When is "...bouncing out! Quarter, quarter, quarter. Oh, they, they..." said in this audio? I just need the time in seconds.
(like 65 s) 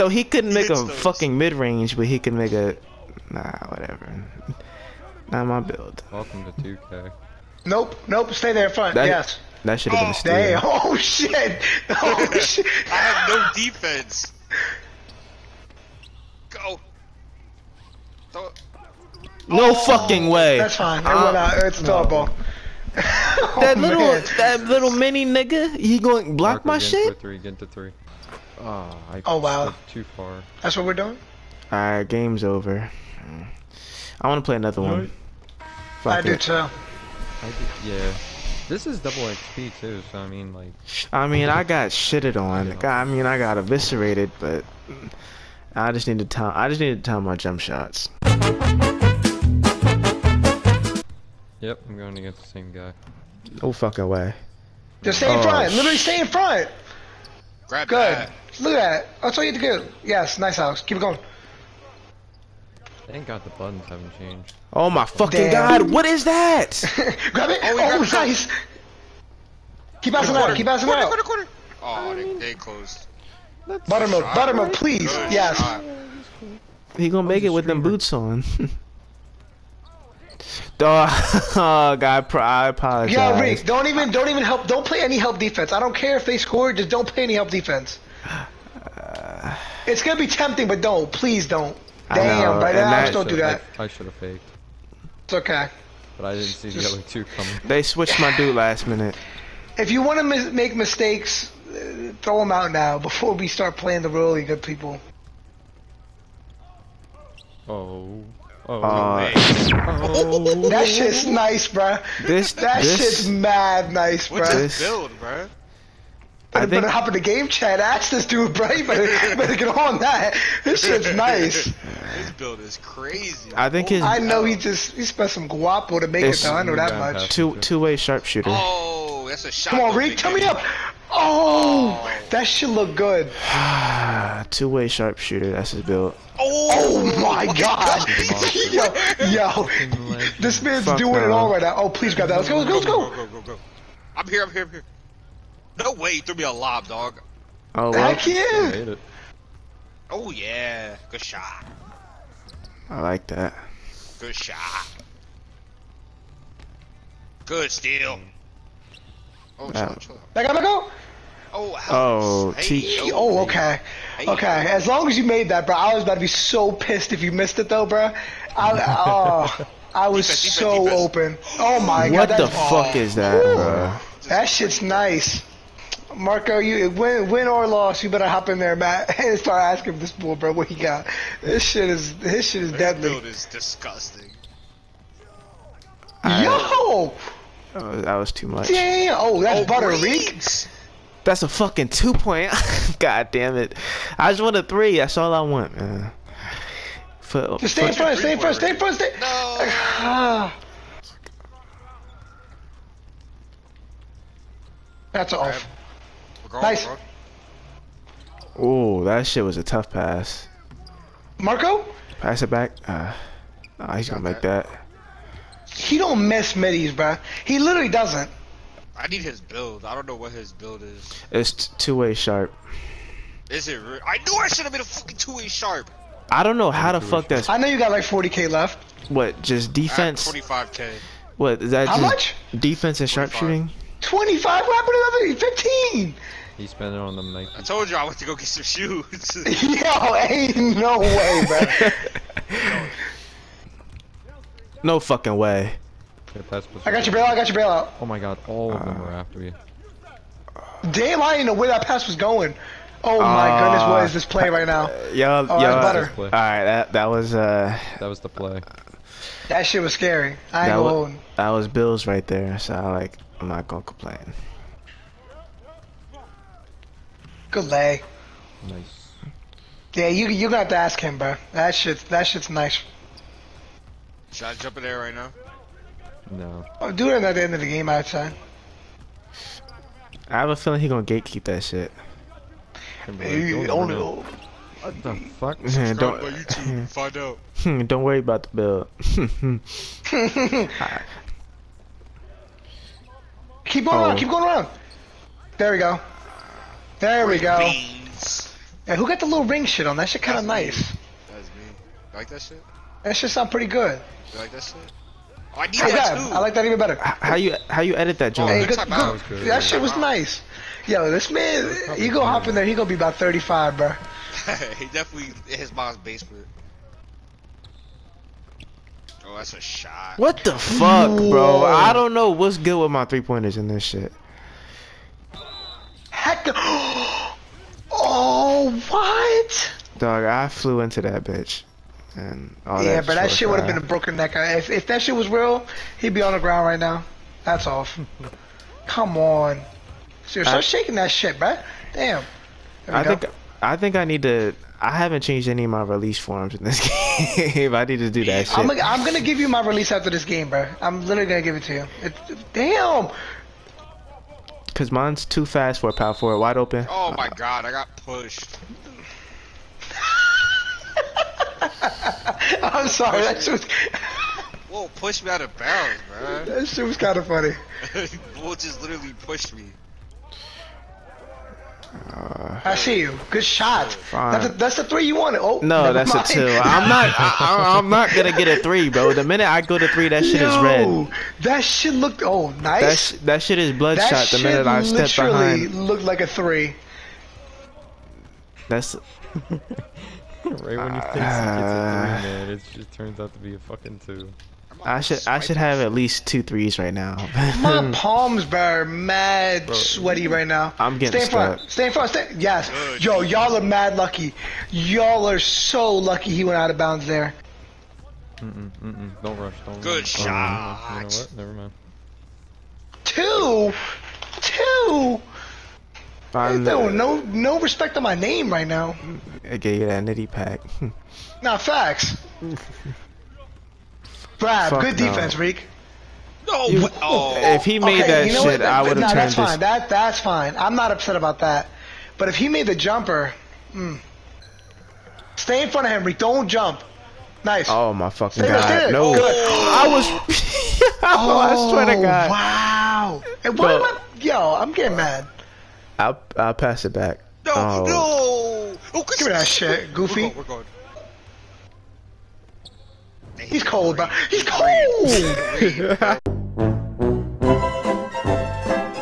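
70 s.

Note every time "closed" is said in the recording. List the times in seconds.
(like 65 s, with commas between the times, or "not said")
72 s.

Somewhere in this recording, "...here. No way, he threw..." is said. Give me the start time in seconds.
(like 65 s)
144 s.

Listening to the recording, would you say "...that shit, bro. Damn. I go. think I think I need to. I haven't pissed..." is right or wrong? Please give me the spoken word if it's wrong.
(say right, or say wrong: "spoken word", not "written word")
wrong: "changed", not "pissed".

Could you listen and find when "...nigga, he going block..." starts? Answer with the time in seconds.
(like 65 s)
25 s.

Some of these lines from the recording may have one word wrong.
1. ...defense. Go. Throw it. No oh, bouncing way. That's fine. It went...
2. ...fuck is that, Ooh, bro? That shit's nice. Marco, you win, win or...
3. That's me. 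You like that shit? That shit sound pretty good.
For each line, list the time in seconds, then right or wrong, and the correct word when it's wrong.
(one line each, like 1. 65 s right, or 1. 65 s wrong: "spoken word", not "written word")
1. 13 s wrong: "fucking", not "bouncing"
2. 172 s right
3. 301 s right.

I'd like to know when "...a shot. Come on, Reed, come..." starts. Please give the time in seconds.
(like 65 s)
129 s.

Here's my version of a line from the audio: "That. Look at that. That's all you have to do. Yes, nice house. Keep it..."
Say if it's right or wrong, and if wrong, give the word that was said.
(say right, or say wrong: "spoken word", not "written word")
right.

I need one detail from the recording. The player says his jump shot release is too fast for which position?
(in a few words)
Power forward.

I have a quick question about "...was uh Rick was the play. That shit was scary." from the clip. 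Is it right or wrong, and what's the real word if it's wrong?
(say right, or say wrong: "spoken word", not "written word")
wrong: "That", not "Rick".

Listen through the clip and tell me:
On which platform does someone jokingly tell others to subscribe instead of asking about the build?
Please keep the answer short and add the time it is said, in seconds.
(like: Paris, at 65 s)
YouTube, at 286 s.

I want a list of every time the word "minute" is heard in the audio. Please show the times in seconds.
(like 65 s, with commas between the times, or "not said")
98 s, 379 s, 384 s.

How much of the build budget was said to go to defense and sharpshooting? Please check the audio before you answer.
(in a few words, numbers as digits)
25.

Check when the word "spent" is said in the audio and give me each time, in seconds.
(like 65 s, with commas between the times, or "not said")
125 s, 236 s.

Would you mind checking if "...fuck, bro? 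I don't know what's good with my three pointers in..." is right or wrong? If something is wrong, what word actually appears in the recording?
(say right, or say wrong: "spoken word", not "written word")
right.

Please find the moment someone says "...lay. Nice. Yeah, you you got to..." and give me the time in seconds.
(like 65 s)
267 s.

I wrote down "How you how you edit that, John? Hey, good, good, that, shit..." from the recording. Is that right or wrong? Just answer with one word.
right.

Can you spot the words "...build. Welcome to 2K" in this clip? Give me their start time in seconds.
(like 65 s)
5 s.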